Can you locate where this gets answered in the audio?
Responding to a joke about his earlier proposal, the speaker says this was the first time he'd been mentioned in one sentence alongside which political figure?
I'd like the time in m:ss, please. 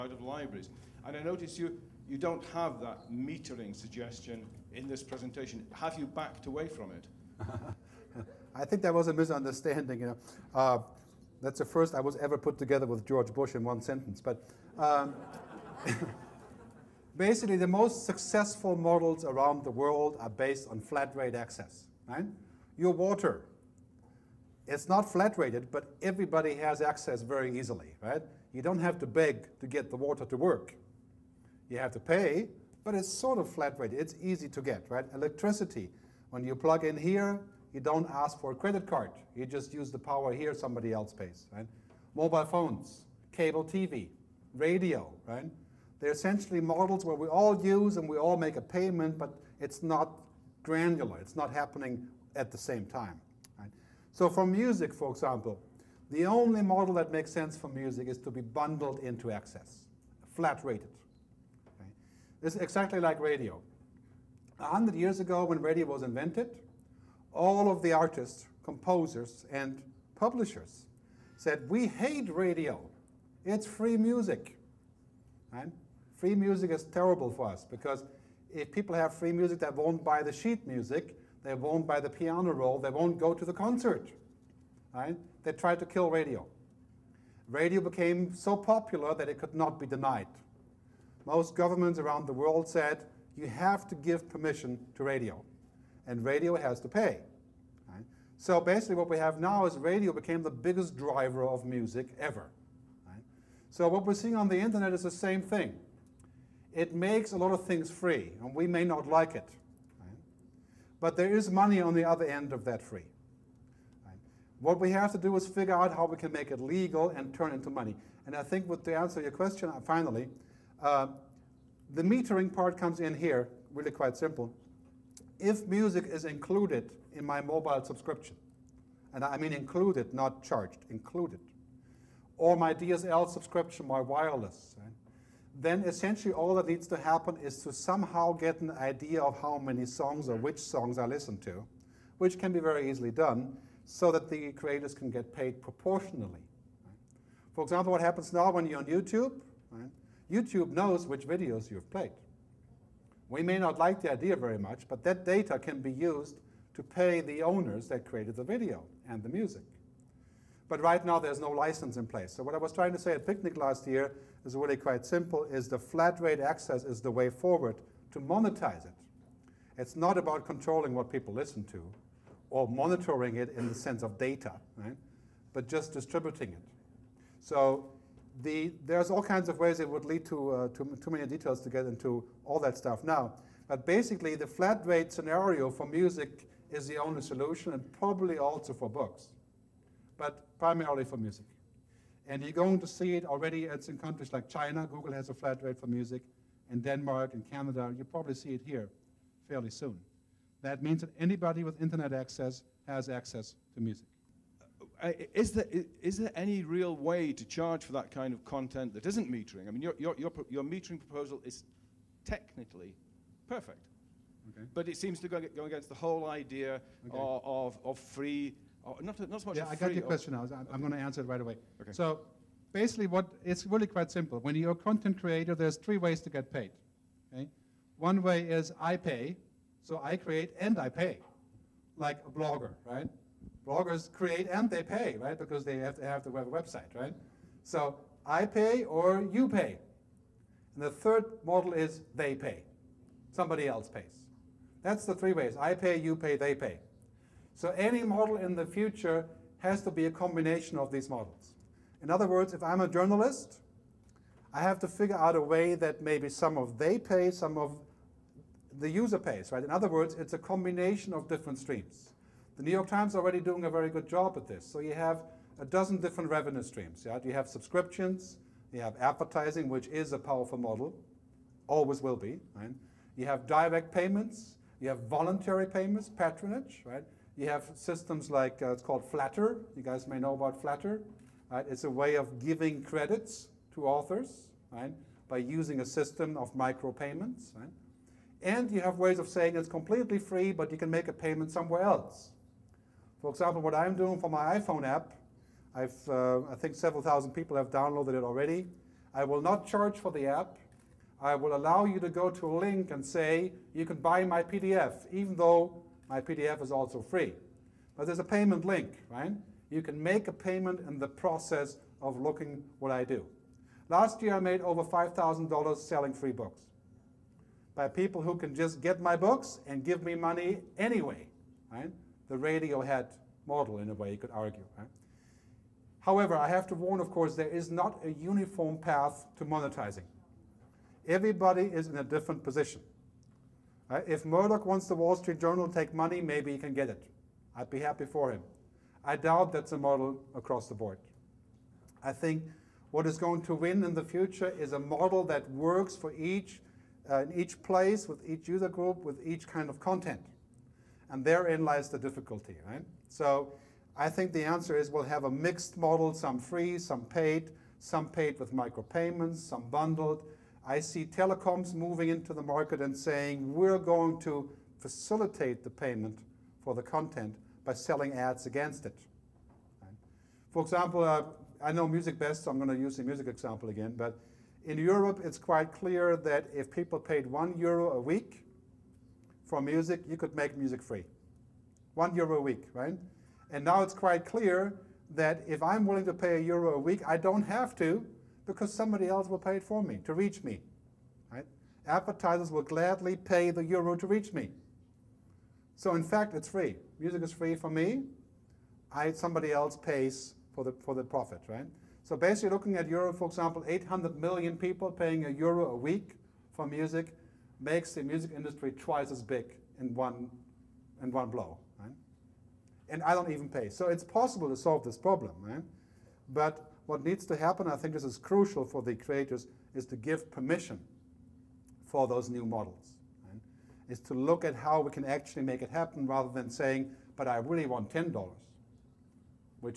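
0:13.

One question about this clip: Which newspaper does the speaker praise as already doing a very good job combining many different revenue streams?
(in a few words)
The New York Times.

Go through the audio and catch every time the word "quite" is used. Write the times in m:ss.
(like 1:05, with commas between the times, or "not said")
2:03, 2:44, 3:43, 6:15, 6:23.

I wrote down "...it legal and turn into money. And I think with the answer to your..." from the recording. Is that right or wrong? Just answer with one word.
right.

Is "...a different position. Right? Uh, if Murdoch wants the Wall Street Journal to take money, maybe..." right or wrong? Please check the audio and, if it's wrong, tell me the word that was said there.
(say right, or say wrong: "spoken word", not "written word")
right.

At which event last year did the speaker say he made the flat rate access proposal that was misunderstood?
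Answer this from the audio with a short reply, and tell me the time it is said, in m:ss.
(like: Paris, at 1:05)
Picnic, at 2:43.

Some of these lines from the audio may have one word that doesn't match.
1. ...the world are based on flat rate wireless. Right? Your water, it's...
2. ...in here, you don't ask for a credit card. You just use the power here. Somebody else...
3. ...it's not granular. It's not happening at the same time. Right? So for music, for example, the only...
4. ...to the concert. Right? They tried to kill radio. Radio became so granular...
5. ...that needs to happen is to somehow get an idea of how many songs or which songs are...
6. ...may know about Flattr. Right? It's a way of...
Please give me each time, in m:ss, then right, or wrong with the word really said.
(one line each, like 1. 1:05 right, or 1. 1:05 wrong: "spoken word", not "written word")
1. 0:19 wrong: "access", not "wireless"
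2. 0:36 right
3. 0:49 right
4. 1:23 wrong: "popular", not "granular"
5. 2:16 right
6. 4:40 right.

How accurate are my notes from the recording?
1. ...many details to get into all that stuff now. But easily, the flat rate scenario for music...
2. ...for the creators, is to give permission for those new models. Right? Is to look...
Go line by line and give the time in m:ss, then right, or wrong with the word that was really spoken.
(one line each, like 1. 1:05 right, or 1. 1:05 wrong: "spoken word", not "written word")
1. 3:01 wrong: "basically", not "easily"
2. 6:58 right.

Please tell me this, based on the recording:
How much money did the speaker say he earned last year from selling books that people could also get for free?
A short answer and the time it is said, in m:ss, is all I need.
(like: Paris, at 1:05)
$5,000, at 5:14.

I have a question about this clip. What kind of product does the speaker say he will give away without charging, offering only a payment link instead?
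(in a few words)
iPhone app.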